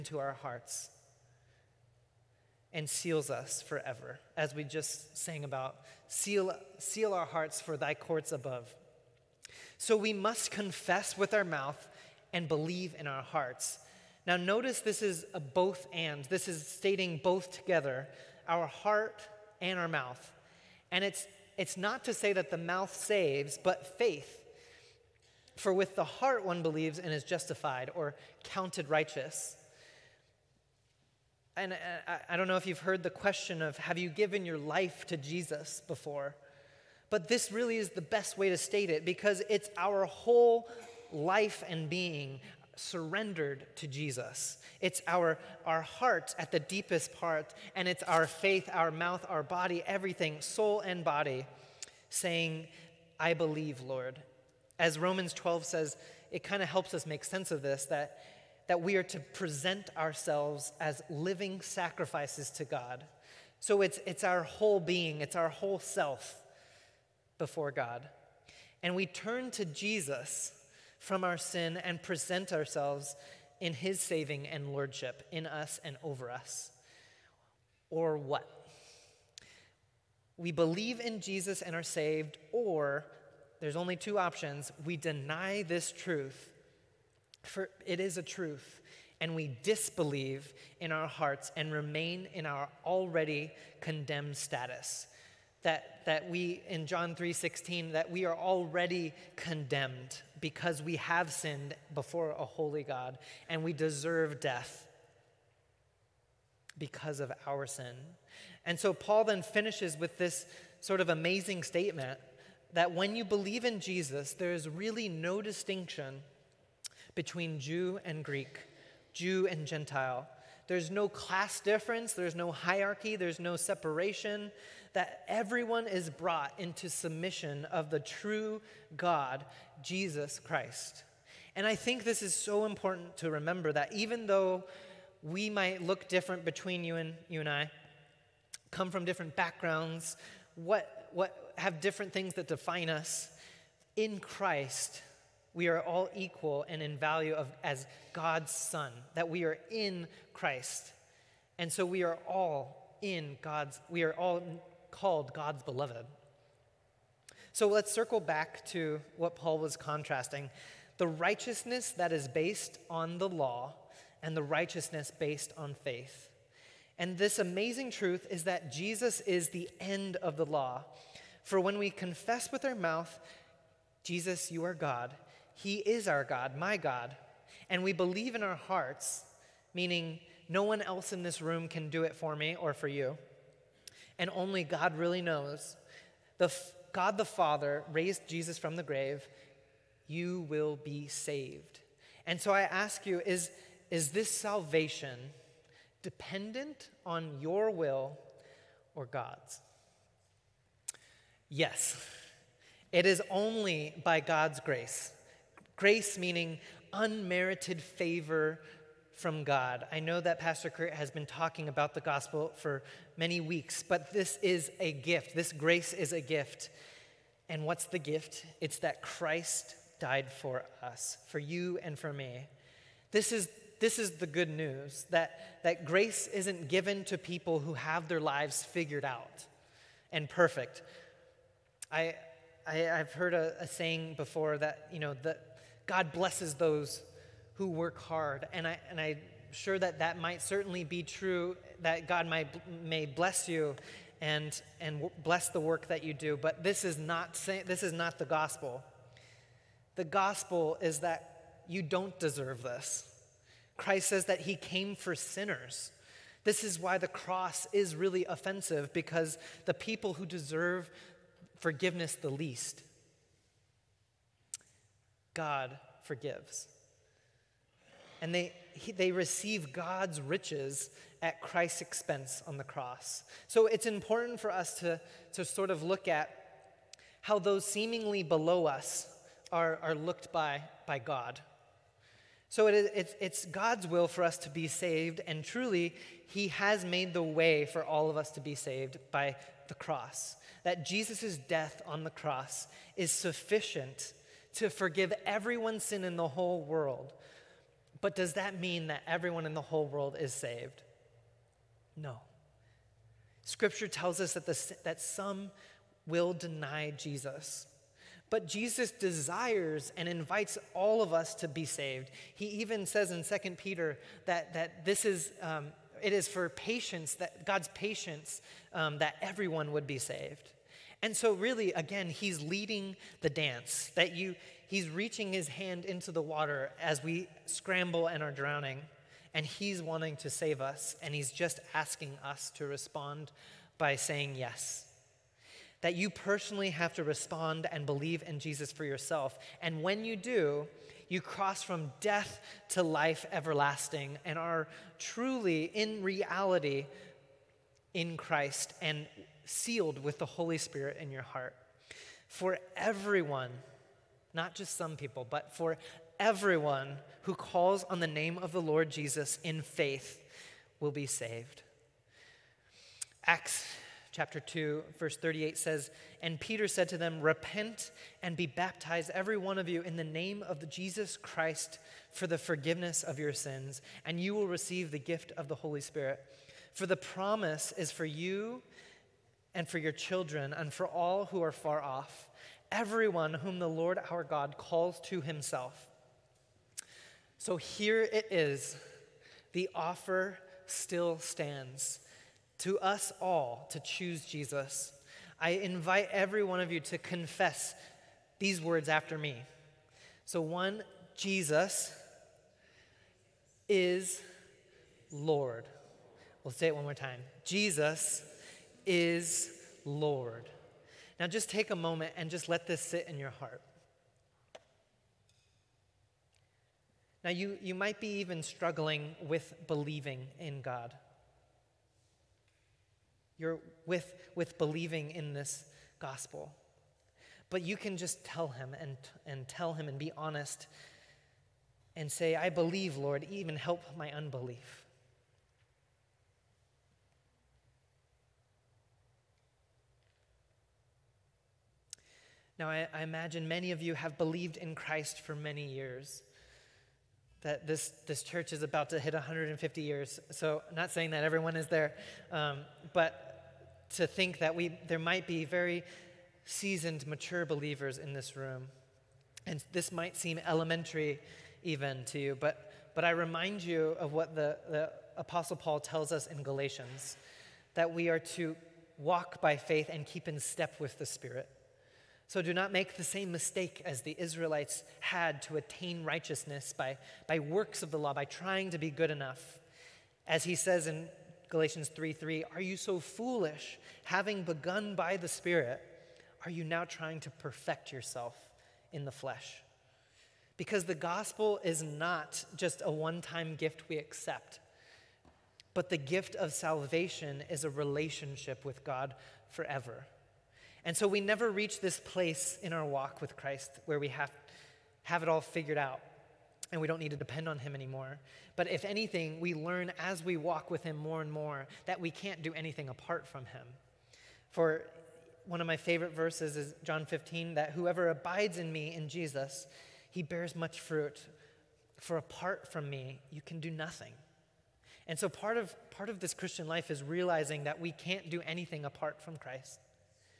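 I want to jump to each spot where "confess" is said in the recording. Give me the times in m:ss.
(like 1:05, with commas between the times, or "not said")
0:10, 2:51, 6:36.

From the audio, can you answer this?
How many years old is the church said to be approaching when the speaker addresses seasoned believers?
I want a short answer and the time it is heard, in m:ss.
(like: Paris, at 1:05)
150, at 7:29.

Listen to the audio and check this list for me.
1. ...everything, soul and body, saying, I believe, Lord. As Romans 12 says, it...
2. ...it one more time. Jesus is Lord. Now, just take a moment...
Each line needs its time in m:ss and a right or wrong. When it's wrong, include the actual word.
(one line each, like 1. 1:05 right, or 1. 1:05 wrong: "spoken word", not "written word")
1. 0:49 right
2. 6:46 right.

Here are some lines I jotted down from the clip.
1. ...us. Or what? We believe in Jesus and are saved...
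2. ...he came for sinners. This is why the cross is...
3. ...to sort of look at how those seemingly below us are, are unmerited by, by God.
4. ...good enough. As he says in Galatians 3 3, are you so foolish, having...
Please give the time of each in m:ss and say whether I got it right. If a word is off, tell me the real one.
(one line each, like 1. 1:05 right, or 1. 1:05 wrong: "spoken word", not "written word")
1. 1:16 right
2. 4:14 right
3. 4:35 wrong: "looked", not "unmerited"
4. 7:58 right.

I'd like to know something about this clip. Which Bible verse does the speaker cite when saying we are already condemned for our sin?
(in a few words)
John 3:16.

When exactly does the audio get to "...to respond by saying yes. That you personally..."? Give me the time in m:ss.
5:32.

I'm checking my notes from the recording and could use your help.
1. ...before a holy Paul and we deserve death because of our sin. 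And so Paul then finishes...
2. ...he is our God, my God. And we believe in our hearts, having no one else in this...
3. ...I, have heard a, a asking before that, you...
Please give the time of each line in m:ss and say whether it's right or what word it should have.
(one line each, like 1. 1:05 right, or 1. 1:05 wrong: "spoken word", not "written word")
1. 1:41 wrong: "God", not "Paul"
2. 2:55 wrong: "meaning", not "having"
3. 3:52 wrong: "saying", not "asking".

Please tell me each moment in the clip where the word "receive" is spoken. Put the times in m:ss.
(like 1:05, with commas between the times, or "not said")
4:29, 6:14.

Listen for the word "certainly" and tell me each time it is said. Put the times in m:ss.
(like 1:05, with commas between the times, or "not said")
4:00.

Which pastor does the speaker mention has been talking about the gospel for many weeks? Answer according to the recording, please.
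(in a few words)
Pastor Kurt.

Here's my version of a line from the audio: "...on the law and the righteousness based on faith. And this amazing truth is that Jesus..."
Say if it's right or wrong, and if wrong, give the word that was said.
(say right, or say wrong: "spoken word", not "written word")
right.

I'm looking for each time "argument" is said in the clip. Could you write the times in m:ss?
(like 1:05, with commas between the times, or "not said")
not said.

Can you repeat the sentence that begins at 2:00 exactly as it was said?
There's no class difference, there's no hierarchy, there's no separation, that everyone is brought into submission of the true God, Jesus Christ.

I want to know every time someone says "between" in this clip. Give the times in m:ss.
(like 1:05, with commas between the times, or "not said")
1:57, 2:16.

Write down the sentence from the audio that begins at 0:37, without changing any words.
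But this really is the best way to state it because it's our whole life and being, surrendered to Jesus.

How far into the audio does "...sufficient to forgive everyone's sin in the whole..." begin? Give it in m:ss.
4:53.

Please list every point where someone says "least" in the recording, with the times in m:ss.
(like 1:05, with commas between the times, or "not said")
4:22.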